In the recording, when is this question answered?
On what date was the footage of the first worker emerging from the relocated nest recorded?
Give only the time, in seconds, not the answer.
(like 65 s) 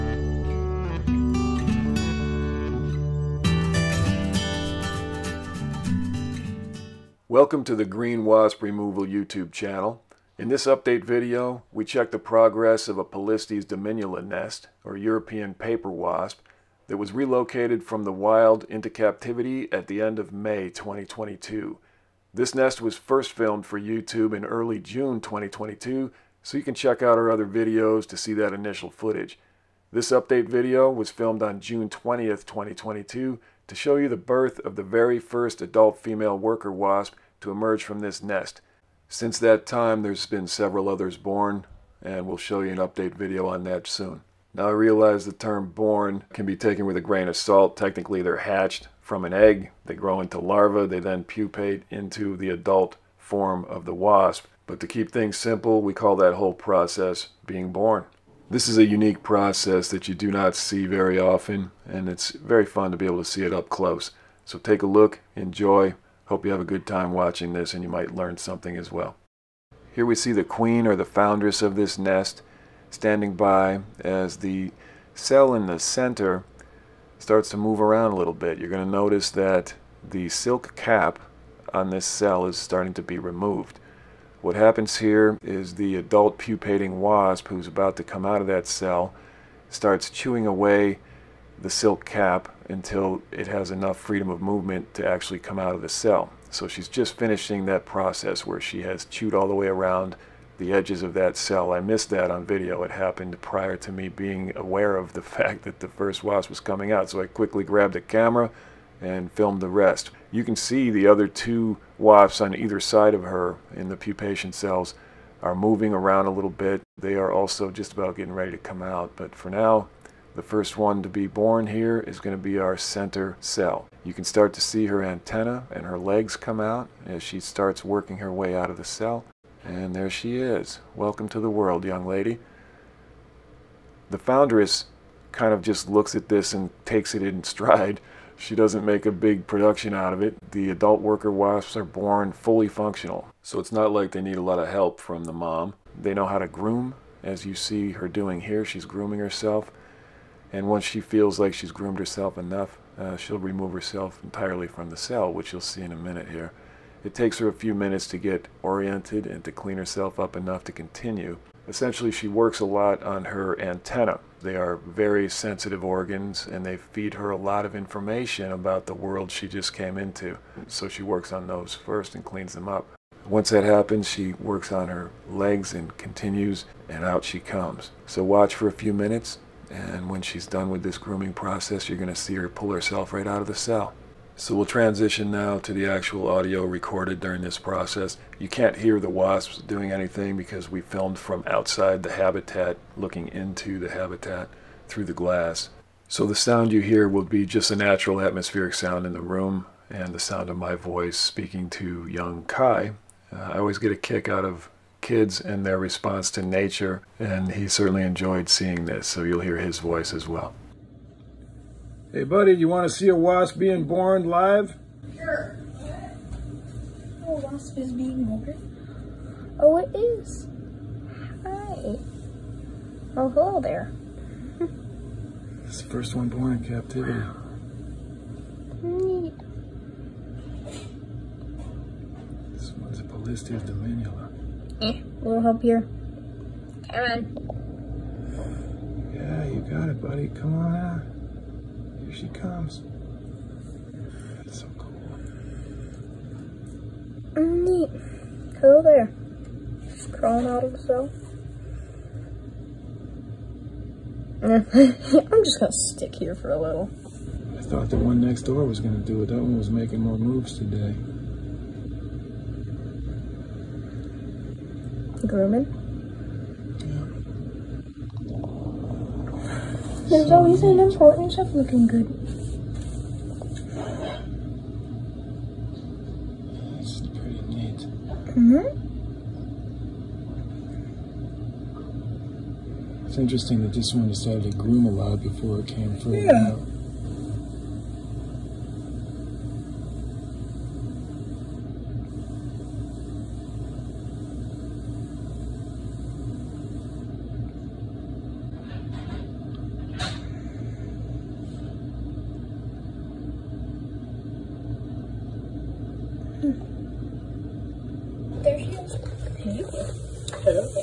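31 s.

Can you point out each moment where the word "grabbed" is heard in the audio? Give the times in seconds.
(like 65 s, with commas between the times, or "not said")
107 s.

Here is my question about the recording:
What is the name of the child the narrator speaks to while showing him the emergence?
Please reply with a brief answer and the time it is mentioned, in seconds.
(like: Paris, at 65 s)
Kai, at 202 s.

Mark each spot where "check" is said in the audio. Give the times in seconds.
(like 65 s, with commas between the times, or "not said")
11 s, 26 s.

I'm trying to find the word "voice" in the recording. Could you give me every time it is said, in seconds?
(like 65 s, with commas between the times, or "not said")
200 s, 209 s.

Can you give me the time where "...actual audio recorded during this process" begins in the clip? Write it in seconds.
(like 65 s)
185 s.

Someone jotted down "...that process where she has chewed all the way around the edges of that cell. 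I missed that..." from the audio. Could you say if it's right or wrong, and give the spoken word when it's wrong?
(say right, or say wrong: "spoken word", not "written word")
right.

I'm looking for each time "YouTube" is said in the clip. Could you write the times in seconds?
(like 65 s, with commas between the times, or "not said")
9 s, 23 s.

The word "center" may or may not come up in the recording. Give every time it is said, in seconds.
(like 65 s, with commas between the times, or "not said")
75 s, 122 s.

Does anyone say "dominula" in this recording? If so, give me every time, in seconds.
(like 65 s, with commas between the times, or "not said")
13 s, 233 s.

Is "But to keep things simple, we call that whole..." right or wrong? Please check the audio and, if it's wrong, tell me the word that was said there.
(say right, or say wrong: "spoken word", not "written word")
right.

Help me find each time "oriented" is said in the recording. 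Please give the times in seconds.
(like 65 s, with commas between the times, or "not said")
158 s.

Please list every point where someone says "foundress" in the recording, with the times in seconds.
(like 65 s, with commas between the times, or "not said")
71 s, 134 s.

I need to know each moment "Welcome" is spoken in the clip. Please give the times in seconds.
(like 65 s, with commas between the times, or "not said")
7 s, 130 s.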